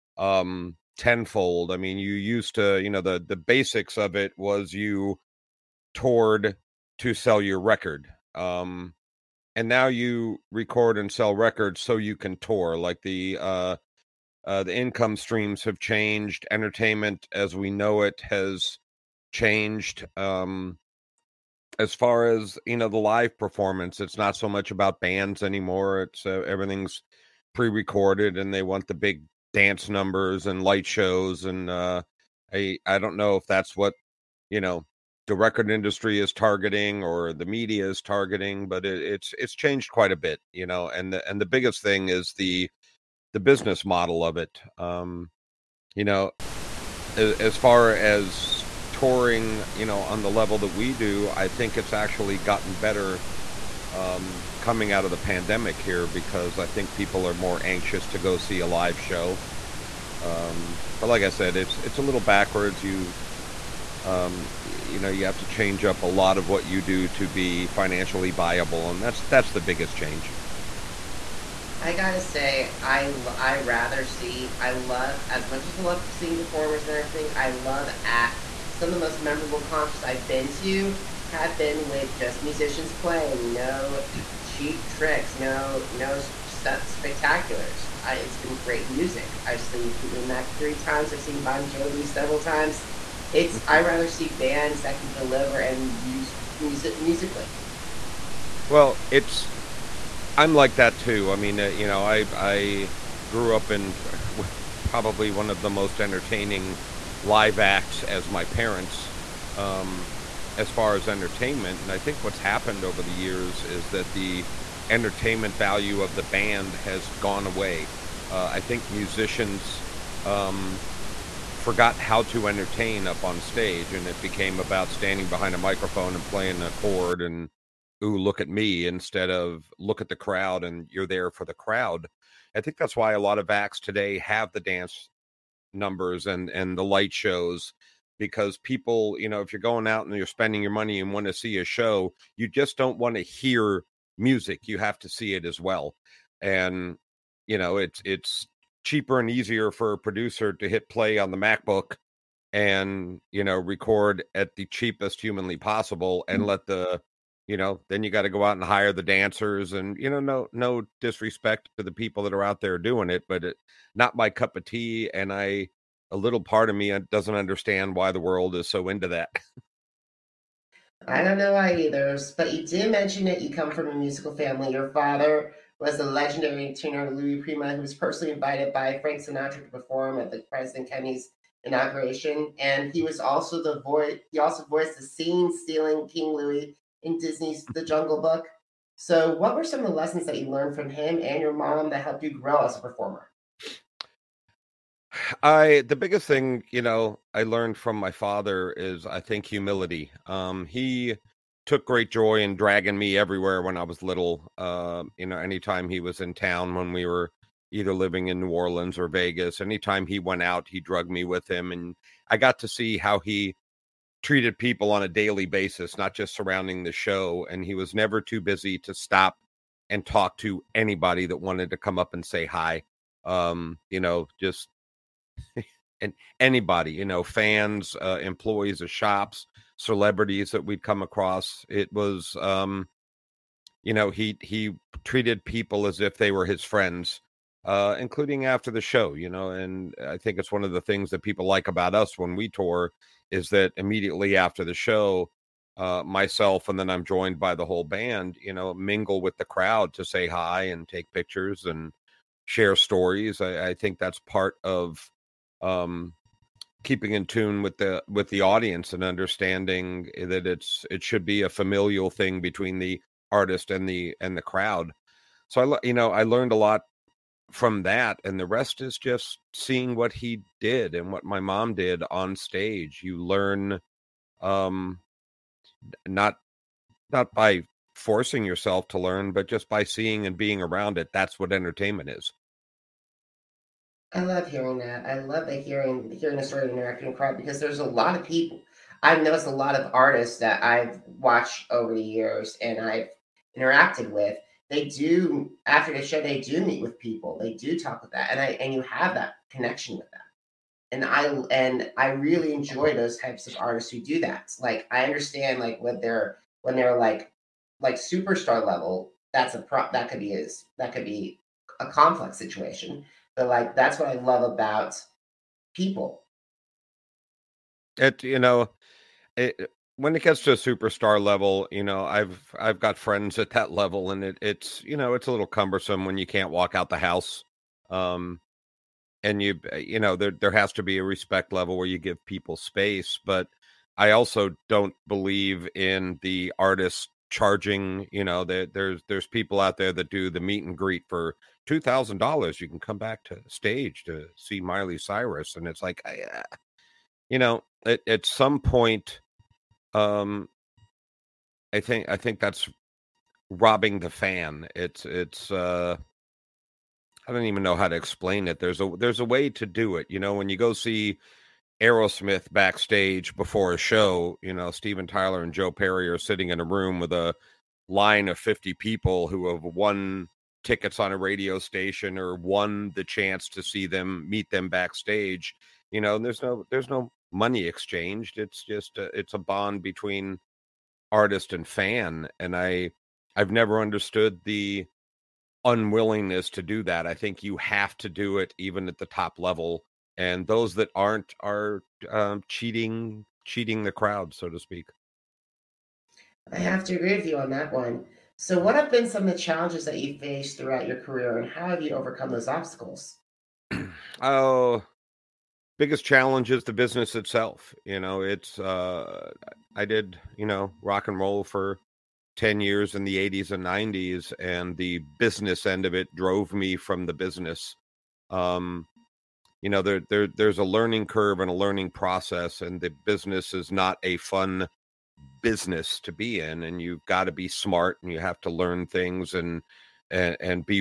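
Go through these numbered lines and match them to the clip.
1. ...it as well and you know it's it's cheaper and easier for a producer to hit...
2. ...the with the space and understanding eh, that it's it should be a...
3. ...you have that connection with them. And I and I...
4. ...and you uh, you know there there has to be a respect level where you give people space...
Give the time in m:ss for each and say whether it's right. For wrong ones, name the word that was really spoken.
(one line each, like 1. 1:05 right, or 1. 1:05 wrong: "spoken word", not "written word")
1. 2:25 right
2. 4:17 wrong: "audience", not "space"
3. 4:58 right
4. 5:29 right.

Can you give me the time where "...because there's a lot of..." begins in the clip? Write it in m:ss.
4:47.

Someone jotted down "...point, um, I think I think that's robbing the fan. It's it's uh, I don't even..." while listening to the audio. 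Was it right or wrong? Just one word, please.
right.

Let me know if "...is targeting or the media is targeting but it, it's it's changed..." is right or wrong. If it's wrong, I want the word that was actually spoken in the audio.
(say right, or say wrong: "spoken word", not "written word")
right.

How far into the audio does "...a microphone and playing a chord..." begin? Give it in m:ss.
2:05.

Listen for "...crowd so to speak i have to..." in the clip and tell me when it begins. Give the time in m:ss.
6:33.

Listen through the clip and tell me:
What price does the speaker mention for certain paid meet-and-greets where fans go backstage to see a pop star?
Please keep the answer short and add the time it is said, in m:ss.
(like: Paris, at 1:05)
$2,000, at 5:41.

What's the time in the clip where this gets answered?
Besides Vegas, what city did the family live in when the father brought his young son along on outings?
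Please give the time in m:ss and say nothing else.
3:28.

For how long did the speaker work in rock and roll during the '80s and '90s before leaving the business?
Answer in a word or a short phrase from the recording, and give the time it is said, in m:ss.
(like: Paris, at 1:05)
10 years, at 6:52.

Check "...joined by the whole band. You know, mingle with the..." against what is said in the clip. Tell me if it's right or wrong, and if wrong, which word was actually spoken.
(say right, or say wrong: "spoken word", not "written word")
right.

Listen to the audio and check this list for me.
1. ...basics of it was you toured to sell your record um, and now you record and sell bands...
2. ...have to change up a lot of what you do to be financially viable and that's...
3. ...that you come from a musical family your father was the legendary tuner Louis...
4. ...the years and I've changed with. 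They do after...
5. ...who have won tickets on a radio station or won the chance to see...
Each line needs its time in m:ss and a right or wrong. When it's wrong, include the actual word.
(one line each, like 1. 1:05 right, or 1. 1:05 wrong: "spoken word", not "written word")
1. 0:03 wrong: "records", not "bands"
2. 1:05 right
3. 2:53 right
4. 4:51 wrong: "interacted", not "changed"
5. 6:09 right.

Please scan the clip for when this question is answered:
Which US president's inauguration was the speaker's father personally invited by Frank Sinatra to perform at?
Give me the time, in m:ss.
3:00.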